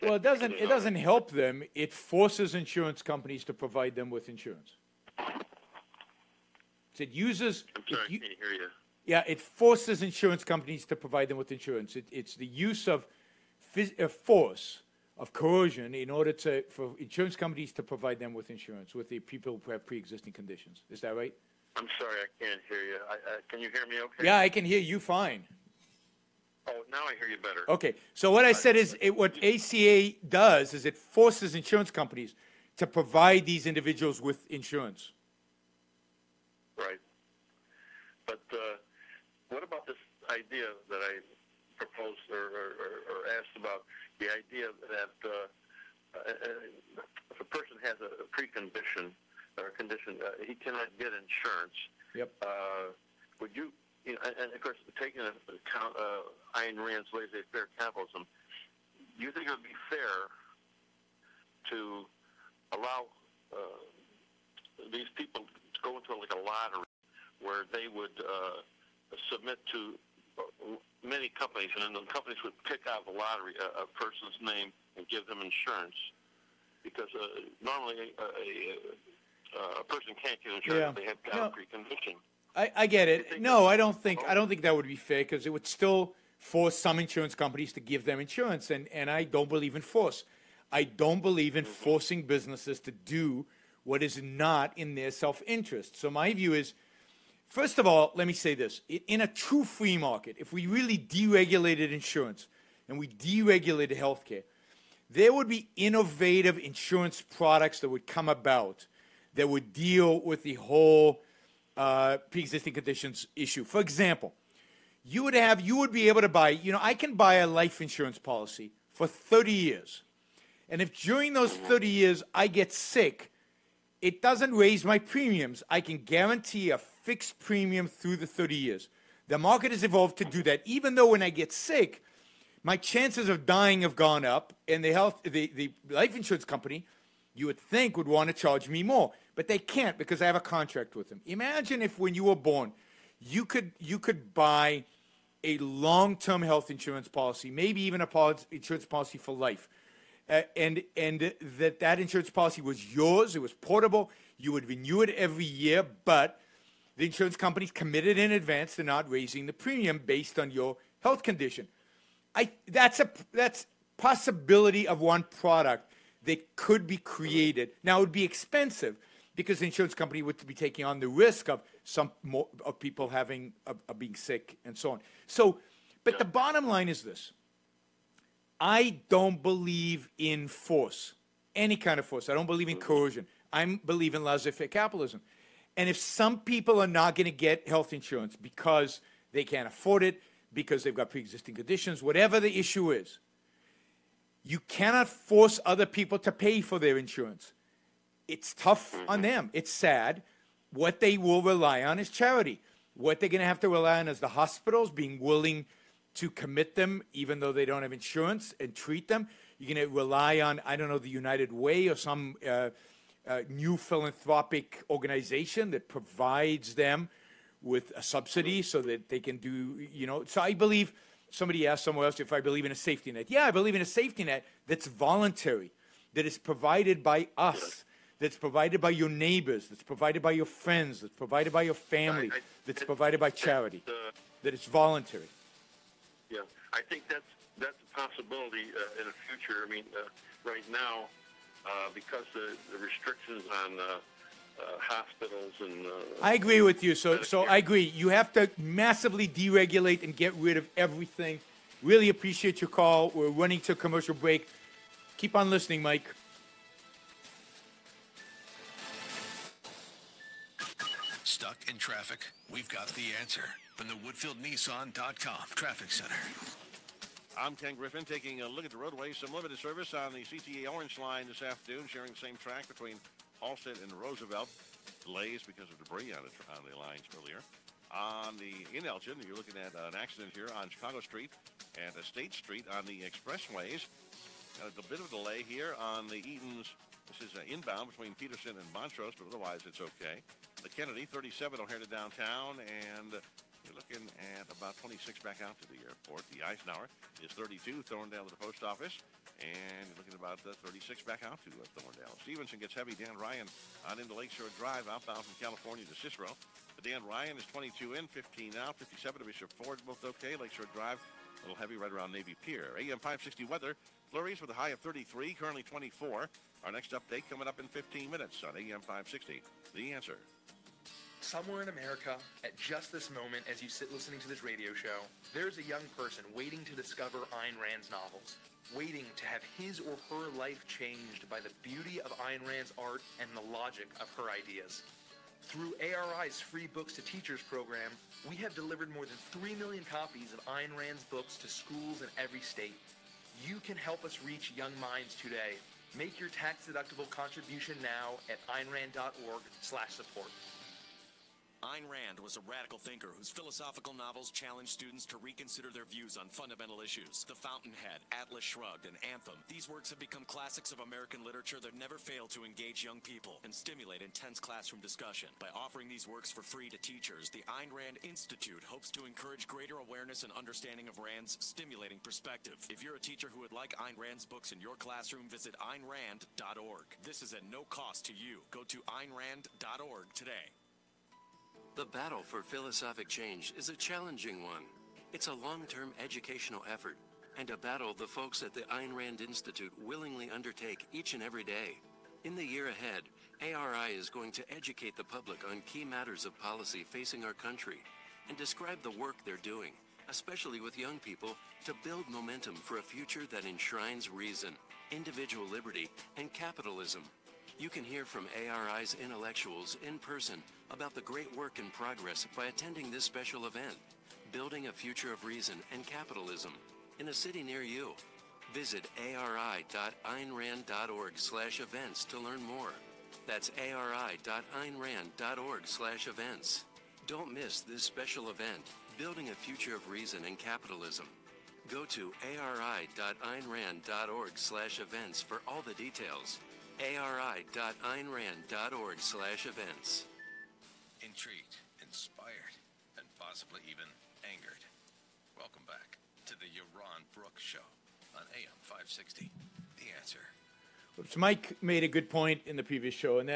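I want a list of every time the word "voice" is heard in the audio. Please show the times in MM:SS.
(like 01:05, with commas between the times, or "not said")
not said.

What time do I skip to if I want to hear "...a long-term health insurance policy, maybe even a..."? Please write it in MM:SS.
02:25.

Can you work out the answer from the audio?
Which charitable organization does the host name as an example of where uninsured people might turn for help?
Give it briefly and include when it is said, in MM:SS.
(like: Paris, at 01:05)
United Way, at 03:30.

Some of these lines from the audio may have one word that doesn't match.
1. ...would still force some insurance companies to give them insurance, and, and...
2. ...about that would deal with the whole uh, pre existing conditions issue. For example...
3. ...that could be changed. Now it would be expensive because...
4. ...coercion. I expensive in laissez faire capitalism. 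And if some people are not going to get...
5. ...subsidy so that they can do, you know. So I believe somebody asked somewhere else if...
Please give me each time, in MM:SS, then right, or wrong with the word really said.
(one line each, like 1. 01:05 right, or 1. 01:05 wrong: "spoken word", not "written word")
1. 01:25 right
2. 01:48 right
3. 02:46 wrong: "created", not "changed"
4. 03:02 wrong: "believe", not "expensive"
5. 03:38 right.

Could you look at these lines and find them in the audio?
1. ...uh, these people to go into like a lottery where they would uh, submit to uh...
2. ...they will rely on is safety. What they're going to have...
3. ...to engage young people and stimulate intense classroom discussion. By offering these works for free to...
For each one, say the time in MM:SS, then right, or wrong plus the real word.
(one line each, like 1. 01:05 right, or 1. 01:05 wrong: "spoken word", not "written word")
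1. 01:03 right
2. 03:20 wrong: "charity", not "safety"
3. 06:02 right.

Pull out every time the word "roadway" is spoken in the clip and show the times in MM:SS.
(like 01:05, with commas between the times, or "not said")
04:28.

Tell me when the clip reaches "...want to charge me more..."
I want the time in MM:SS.
02:18.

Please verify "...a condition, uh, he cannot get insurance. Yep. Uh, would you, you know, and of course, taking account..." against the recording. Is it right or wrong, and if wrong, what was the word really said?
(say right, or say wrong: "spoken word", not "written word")
right.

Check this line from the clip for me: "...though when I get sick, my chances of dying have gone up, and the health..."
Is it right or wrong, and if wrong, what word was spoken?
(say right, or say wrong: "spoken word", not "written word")
right.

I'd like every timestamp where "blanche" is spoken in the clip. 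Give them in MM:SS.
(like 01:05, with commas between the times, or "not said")
not said.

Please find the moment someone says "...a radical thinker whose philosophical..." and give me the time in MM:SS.
05:52.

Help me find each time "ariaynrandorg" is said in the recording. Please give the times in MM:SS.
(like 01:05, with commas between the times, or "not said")
06:59, 07:03, 07:12, 07:16.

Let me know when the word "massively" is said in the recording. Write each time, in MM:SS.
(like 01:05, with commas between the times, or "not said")
04:08.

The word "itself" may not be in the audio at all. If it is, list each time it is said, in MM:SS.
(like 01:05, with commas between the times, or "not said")
not said.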